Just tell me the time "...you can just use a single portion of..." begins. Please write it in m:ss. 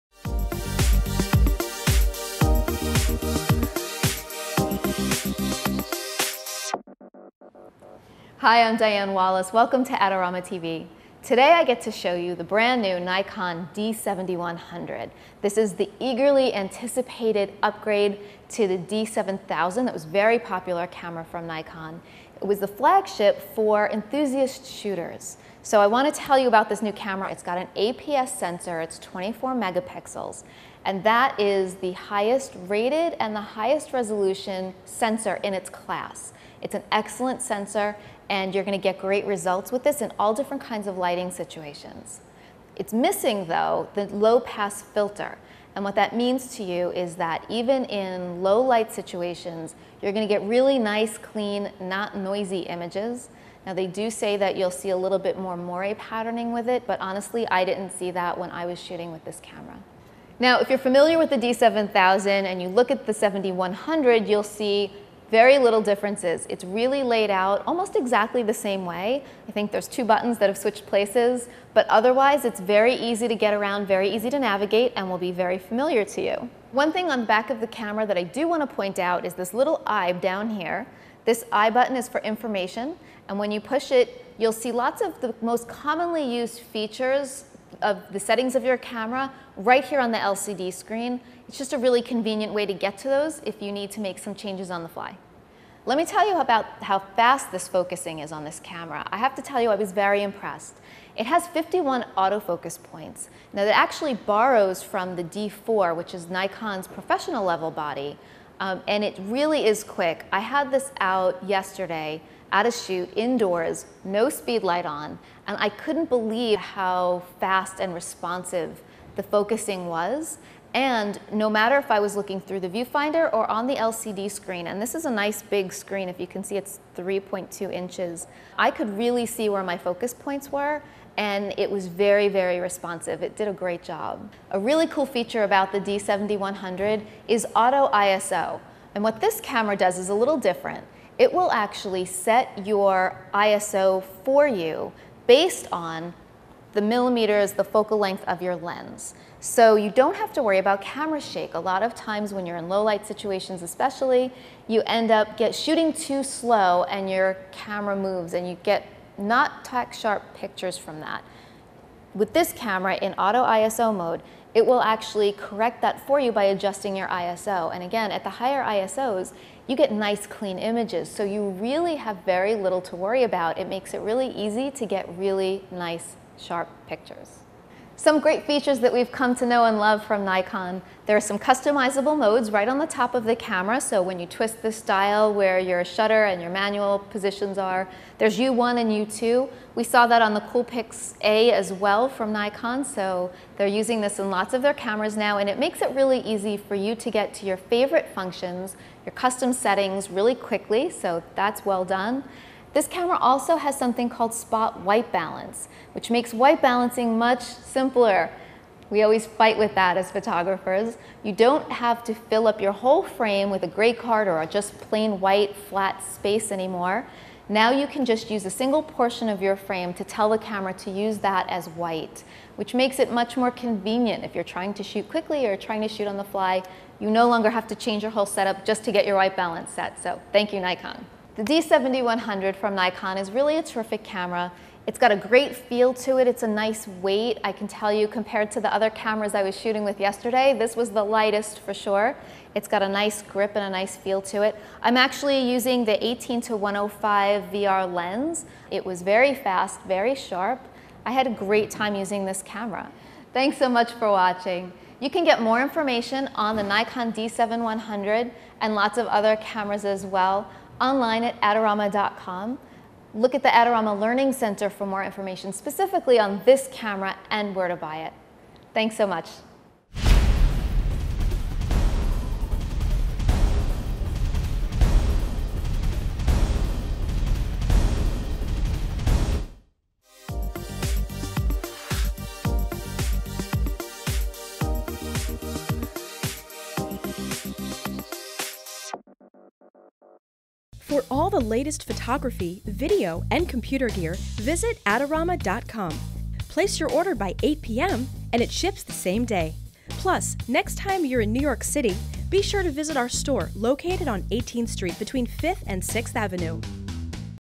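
3:37.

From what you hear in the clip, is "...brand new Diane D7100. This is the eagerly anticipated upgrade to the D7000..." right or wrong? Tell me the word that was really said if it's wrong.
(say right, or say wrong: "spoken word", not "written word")
wrong: "Nikon", not "Diane".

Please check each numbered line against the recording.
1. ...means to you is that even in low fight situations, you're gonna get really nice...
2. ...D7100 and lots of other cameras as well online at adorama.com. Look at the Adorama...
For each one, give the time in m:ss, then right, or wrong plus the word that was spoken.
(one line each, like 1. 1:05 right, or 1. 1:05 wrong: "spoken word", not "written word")
1. 0:46 wrong: "light", not "fight"
2. 4:17 right.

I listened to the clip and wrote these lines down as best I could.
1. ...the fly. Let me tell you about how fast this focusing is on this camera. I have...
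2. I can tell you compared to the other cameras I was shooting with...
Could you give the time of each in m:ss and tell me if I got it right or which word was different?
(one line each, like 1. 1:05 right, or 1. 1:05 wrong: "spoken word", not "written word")
1. 1:34 right
2. 3:57 right.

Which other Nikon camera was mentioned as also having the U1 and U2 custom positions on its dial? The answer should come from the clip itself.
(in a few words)
Coolpix A.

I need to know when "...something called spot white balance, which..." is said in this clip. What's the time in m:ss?
3:23.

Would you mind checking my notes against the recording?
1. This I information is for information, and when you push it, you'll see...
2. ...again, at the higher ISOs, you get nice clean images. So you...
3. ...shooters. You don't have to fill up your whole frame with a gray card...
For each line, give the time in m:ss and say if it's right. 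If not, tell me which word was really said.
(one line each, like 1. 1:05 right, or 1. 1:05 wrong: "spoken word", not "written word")
1. 1:21 wrong: "button", not "information"
2. 2:47 right
3. 3:30 wrong: "photographers", not "shooters".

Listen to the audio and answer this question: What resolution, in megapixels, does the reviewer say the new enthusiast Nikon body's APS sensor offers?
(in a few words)
24 megapixels.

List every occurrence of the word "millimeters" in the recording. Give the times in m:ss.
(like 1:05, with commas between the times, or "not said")
2:26.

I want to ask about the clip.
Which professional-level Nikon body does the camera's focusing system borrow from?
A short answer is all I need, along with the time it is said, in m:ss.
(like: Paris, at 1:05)
D4, at 1:45.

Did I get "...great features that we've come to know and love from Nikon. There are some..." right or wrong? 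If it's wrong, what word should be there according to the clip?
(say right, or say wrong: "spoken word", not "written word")
right.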